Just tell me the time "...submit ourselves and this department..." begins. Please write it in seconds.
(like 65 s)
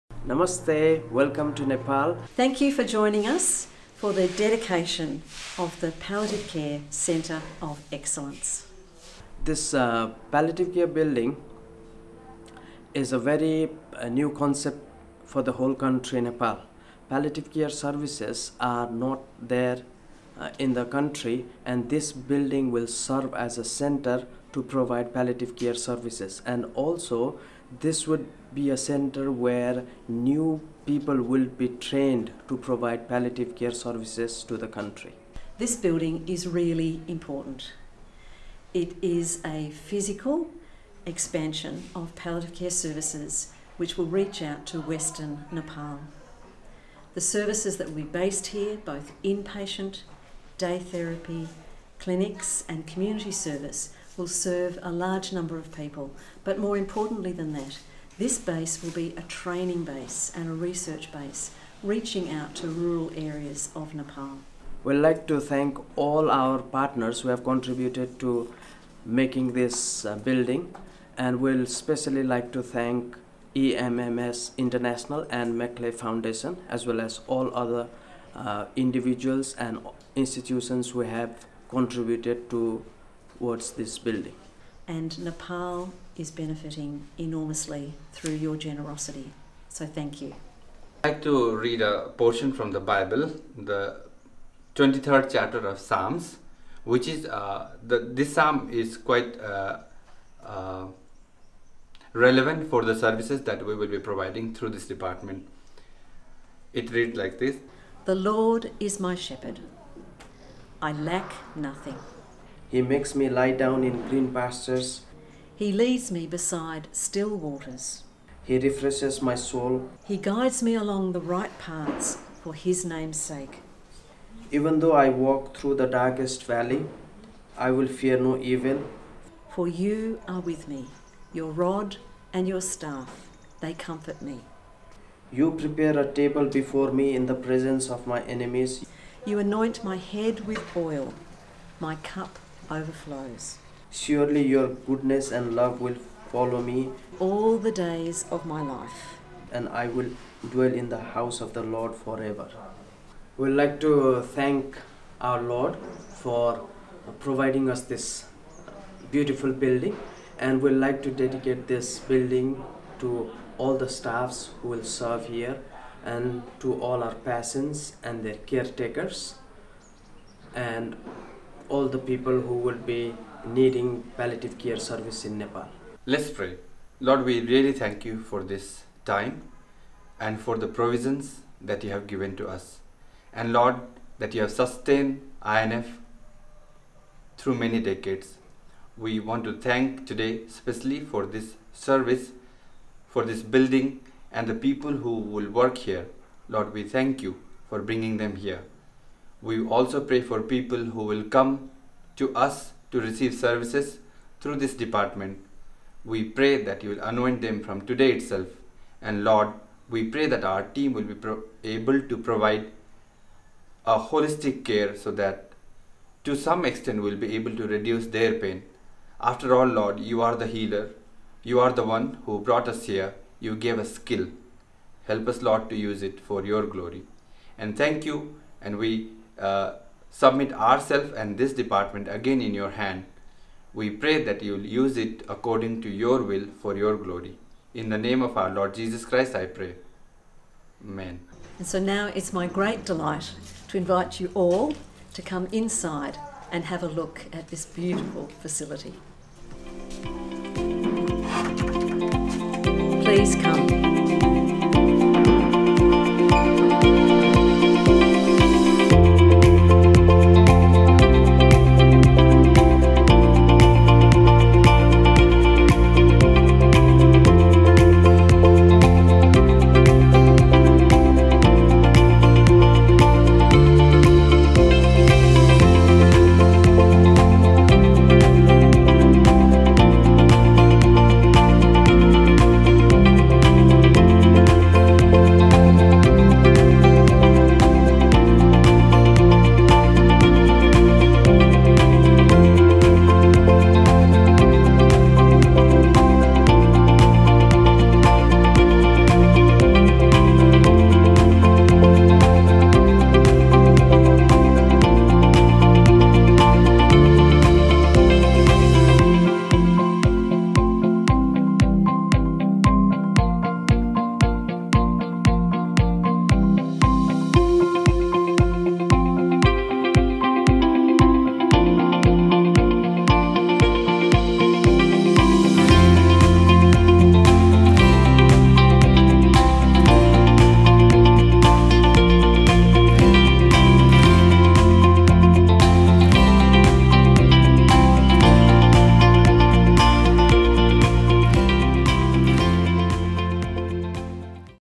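230 s.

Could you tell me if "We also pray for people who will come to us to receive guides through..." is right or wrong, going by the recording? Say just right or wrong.
wrong.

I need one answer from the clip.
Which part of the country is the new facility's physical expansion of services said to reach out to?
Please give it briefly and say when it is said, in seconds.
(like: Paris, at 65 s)
Western Nepal, at 44 s.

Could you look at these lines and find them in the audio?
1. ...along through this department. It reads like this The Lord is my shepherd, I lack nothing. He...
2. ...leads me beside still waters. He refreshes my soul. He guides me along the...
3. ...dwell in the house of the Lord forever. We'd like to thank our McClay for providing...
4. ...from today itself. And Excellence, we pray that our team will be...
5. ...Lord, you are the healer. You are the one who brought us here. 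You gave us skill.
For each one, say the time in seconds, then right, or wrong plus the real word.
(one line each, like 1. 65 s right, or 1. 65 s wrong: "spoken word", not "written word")
1. 103 s wrong: "providing", not "along"
2. 115 s right
3. 150 s wrong: "Lord", not "McClay"
4. 207 s wrong: "Lord", not "Excellence"
5. 219 s right.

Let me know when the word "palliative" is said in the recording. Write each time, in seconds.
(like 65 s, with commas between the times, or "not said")
5 s, 10 s, 17 s, 25 s, 33 s, 42 s, 174 s.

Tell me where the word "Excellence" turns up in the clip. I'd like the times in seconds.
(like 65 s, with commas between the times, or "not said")
7 s.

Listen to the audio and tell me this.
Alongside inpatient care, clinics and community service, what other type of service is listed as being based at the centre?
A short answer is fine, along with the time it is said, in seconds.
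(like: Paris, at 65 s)
Day therapy, at 50 s.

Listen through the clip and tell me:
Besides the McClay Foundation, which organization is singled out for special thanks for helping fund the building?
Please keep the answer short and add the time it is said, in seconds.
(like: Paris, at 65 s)
EMMS International, at 73 s.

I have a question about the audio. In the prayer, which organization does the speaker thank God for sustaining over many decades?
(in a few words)
INF.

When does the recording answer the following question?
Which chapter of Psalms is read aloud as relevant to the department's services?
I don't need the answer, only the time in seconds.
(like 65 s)
94 s.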